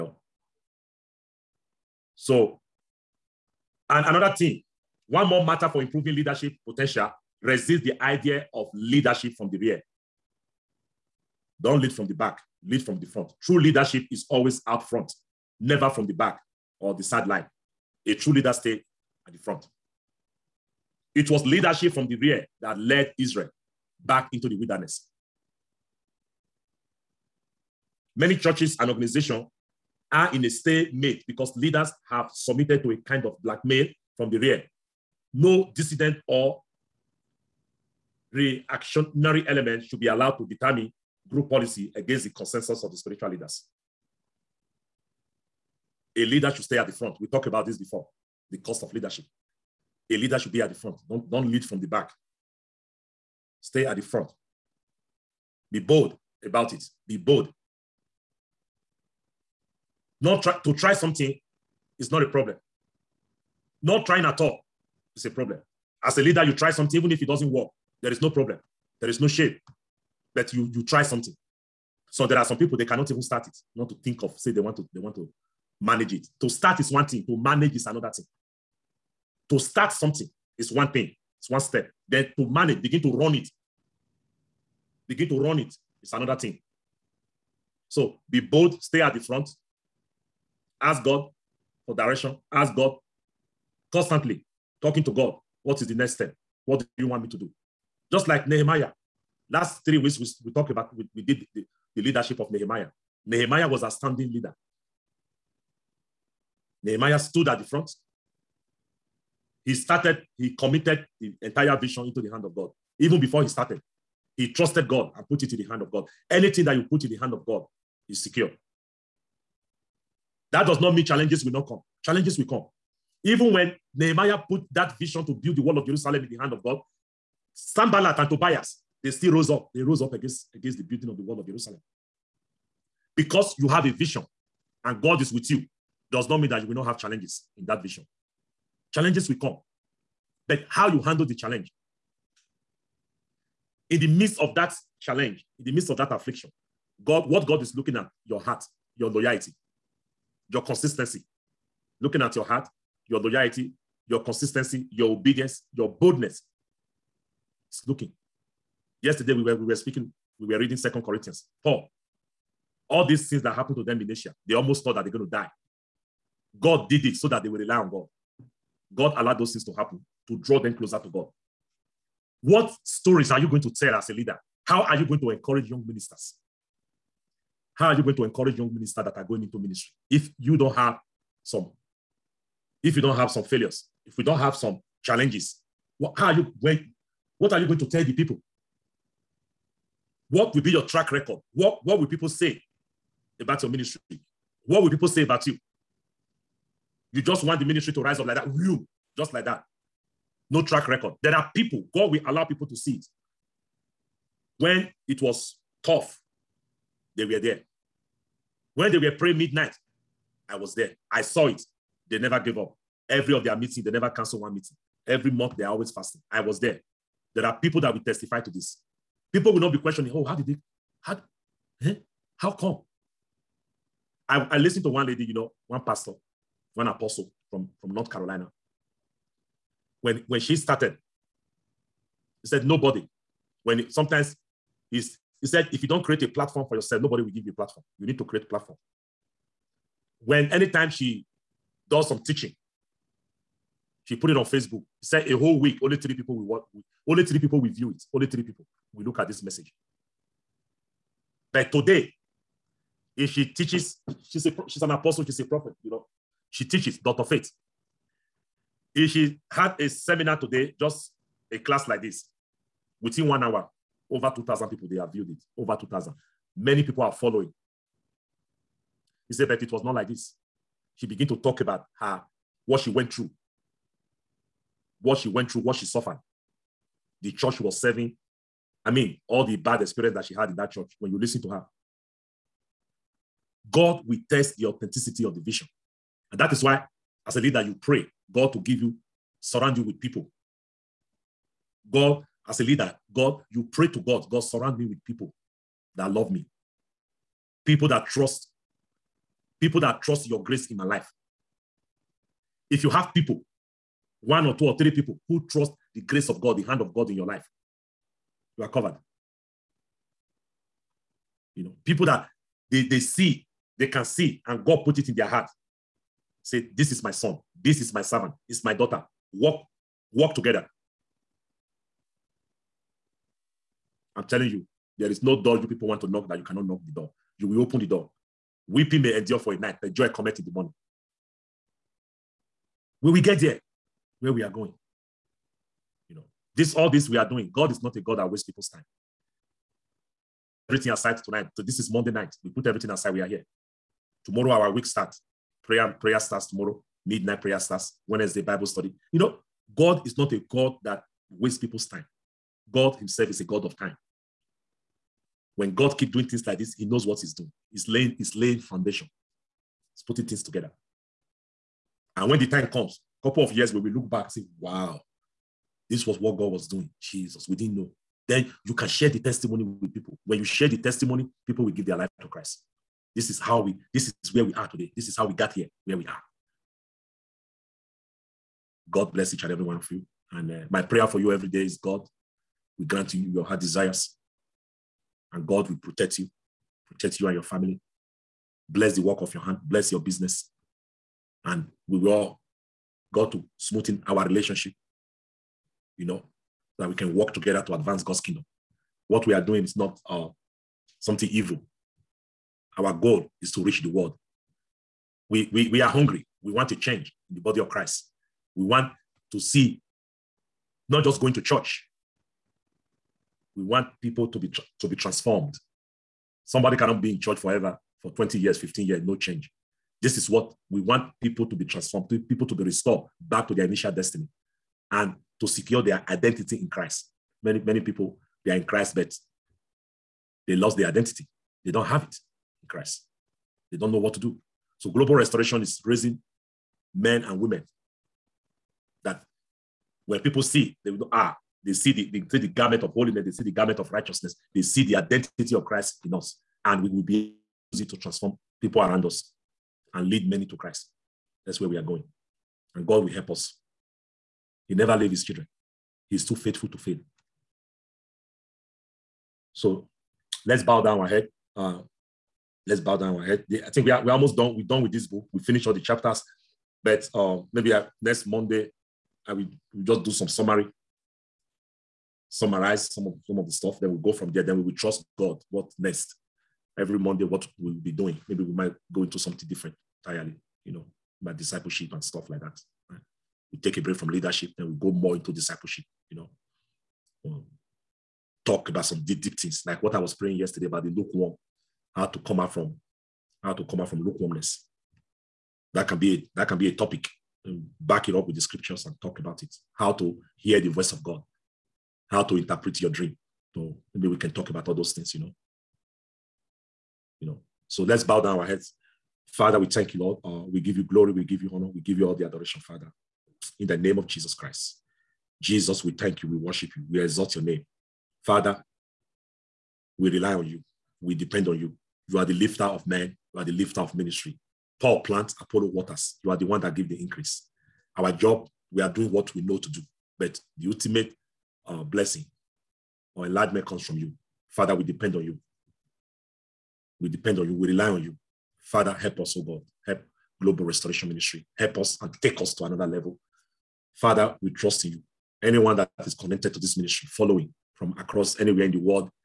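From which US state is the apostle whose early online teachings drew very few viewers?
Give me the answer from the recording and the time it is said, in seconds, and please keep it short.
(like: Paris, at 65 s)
North Carolina, at 227 s.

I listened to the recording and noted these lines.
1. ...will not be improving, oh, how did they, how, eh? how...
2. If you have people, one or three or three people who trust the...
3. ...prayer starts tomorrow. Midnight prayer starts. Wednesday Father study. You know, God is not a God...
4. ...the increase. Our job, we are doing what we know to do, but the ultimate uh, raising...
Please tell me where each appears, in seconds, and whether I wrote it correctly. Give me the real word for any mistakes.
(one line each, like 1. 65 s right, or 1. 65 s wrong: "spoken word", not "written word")
1. 219 s wrong: "questioning", not "improving"
2. 302 s wrong: "two", not "three"
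3. 345 s wrong: "Bible", not "Father"
4. 526 s wrong: "blessing", not "raising".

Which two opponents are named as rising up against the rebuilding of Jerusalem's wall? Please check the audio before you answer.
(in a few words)
Sanballat and Tobias.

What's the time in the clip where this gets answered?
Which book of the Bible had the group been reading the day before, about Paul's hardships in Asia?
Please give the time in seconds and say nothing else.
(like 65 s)
160 s.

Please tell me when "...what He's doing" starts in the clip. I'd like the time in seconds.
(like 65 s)
357 s.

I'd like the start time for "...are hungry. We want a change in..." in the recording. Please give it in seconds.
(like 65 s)
405 s.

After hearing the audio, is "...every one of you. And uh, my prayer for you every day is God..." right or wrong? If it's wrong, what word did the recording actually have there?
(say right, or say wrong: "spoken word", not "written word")
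right.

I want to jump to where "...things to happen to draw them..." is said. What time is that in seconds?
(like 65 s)
169 s.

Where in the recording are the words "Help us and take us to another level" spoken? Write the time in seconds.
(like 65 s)
541 s.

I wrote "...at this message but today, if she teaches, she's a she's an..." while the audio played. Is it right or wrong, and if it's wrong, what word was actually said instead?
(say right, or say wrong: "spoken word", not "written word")
right.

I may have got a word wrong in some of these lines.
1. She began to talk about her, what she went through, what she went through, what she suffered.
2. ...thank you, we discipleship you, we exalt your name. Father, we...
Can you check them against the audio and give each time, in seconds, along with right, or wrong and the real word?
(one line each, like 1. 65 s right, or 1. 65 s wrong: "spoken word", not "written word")
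1. 270 s right
2. 515 s wrong: "worship", not "discipleship".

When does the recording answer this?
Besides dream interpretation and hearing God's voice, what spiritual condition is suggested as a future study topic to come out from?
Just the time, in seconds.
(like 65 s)
494 s.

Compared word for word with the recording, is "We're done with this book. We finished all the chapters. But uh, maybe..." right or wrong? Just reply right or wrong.
right.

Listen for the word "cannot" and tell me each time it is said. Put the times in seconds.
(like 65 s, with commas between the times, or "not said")
72 s, 326 s, 416 s.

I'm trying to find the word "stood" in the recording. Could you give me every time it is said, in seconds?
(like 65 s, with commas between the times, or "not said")
107 s.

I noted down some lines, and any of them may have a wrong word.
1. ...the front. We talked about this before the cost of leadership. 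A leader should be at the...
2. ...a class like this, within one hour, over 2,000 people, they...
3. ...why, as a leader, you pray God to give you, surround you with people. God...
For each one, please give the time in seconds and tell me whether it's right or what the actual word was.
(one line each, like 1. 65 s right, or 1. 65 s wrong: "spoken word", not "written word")
1. 46 s right
2. 261 s right
3. 286 s right.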